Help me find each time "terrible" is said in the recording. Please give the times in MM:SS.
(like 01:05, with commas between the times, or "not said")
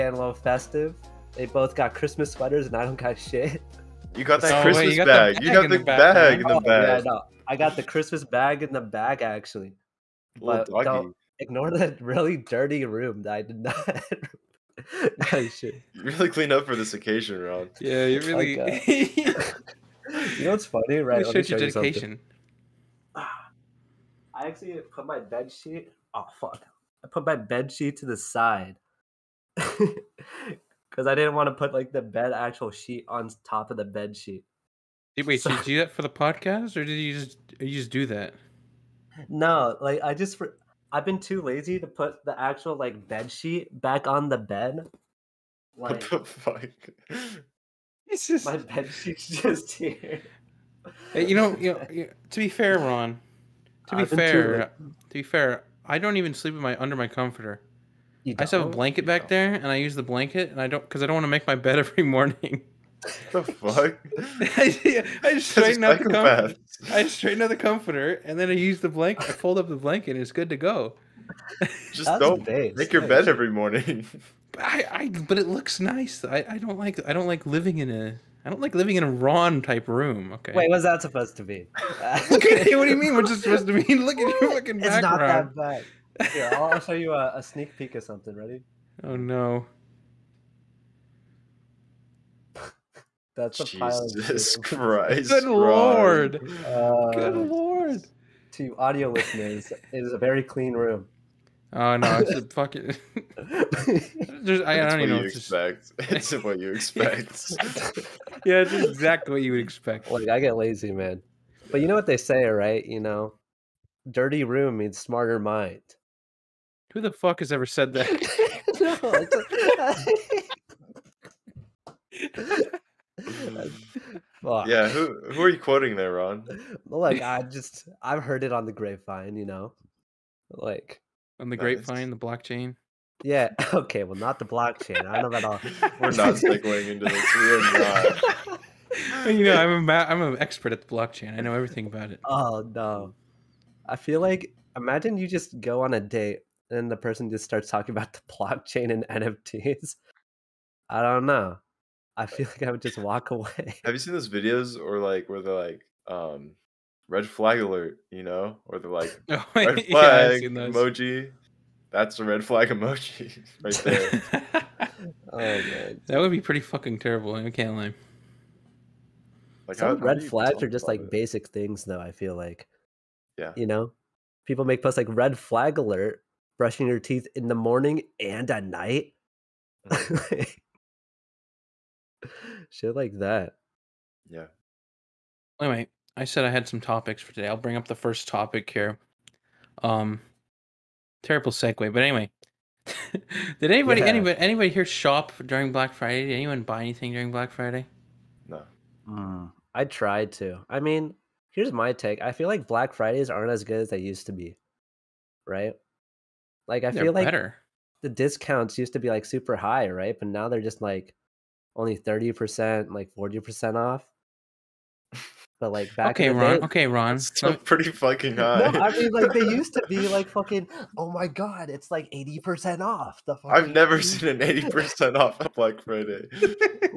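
02:46, 03:11.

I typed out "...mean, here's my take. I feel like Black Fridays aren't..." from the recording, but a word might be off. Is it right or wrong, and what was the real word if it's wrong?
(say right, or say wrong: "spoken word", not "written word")
right.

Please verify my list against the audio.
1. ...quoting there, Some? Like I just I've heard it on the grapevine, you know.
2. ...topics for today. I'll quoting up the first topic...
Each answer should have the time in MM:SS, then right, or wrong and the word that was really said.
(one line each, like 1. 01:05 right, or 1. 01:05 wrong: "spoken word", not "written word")
1. 02:05 wrong: "Ron", not "Some"
2. 03:06 wrong: "bring", not "quoting".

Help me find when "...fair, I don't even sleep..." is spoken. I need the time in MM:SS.
00:55.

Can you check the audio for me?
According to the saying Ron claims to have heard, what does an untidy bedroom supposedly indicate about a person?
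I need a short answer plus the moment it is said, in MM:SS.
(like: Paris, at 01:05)
smarter mind, at 01:54.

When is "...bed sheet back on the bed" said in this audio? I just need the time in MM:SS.
00:43.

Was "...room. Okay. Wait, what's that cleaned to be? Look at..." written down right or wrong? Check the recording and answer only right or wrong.
wrong.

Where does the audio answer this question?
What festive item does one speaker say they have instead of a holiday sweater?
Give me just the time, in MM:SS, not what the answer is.
00:07.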